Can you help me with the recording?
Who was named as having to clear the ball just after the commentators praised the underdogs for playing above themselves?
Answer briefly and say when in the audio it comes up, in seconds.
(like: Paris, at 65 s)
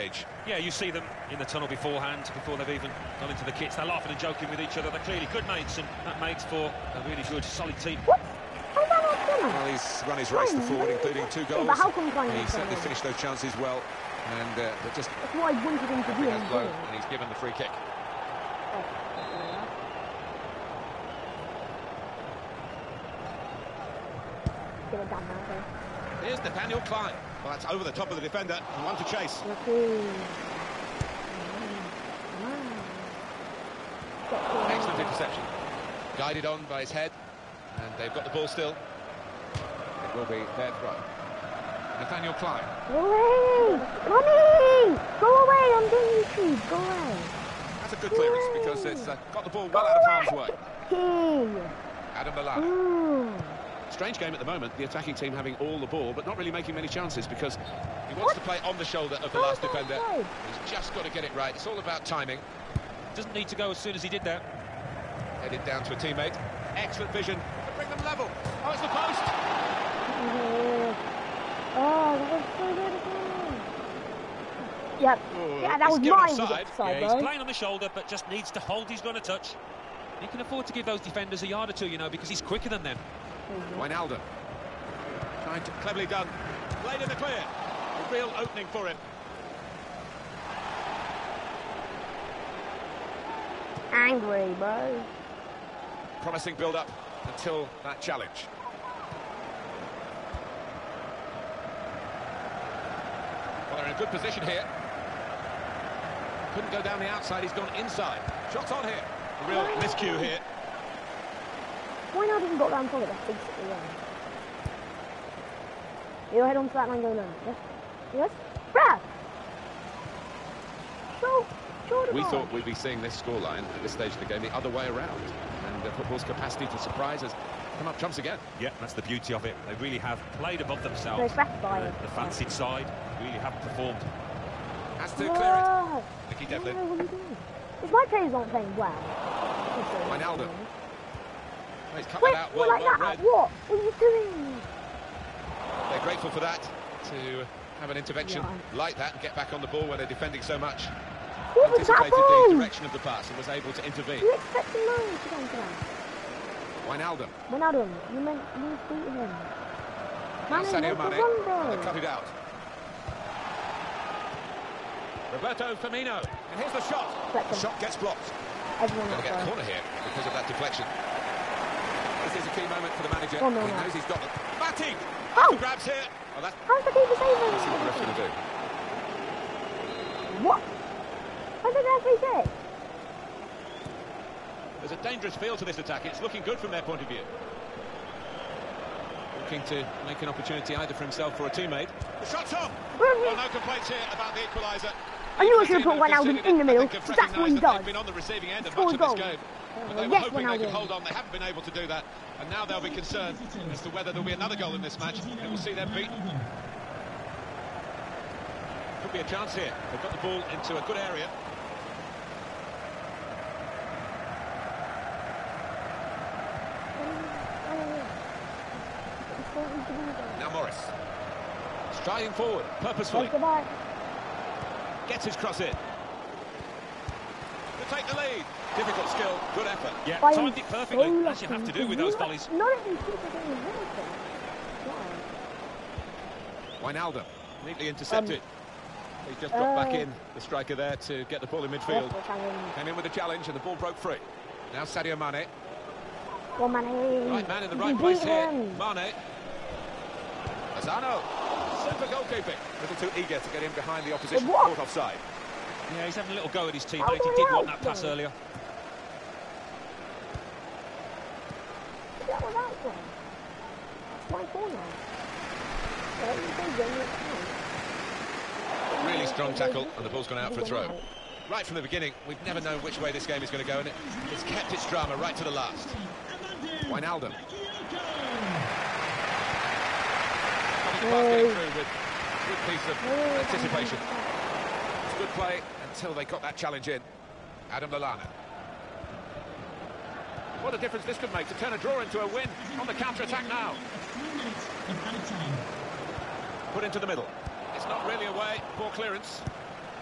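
Nicky Devlin, at 136 s.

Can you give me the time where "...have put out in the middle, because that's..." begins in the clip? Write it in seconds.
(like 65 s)
195 s.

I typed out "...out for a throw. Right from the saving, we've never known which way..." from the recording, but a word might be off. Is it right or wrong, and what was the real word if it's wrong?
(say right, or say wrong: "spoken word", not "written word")
wrong: "beginning", not "saving".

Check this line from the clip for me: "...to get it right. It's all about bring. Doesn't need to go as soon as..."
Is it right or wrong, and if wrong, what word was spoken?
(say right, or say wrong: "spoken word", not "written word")
wrong: "timing", not "bring".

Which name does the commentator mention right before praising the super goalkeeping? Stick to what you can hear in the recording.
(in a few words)
Lozano.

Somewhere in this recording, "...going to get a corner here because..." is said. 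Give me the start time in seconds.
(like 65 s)
169 s.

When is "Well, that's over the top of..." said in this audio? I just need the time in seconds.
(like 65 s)
27 s.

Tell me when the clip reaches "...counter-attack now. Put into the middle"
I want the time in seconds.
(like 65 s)
292 s.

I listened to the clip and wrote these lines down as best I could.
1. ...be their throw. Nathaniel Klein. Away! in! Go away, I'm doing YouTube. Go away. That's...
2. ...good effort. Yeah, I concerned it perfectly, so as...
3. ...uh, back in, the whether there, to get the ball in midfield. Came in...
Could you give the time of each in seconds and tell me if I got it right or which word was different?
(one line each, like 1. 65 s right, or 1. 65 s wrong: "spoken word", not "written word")
1. 40 s right
2. 229 s wrong: "timed", not "concerned"
3. 239 s wrong: "striker", not "whether".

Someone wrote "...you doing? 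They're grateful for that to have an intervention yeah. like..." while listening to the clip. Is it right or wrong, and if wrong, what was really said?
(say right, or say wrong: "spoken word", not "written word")
right.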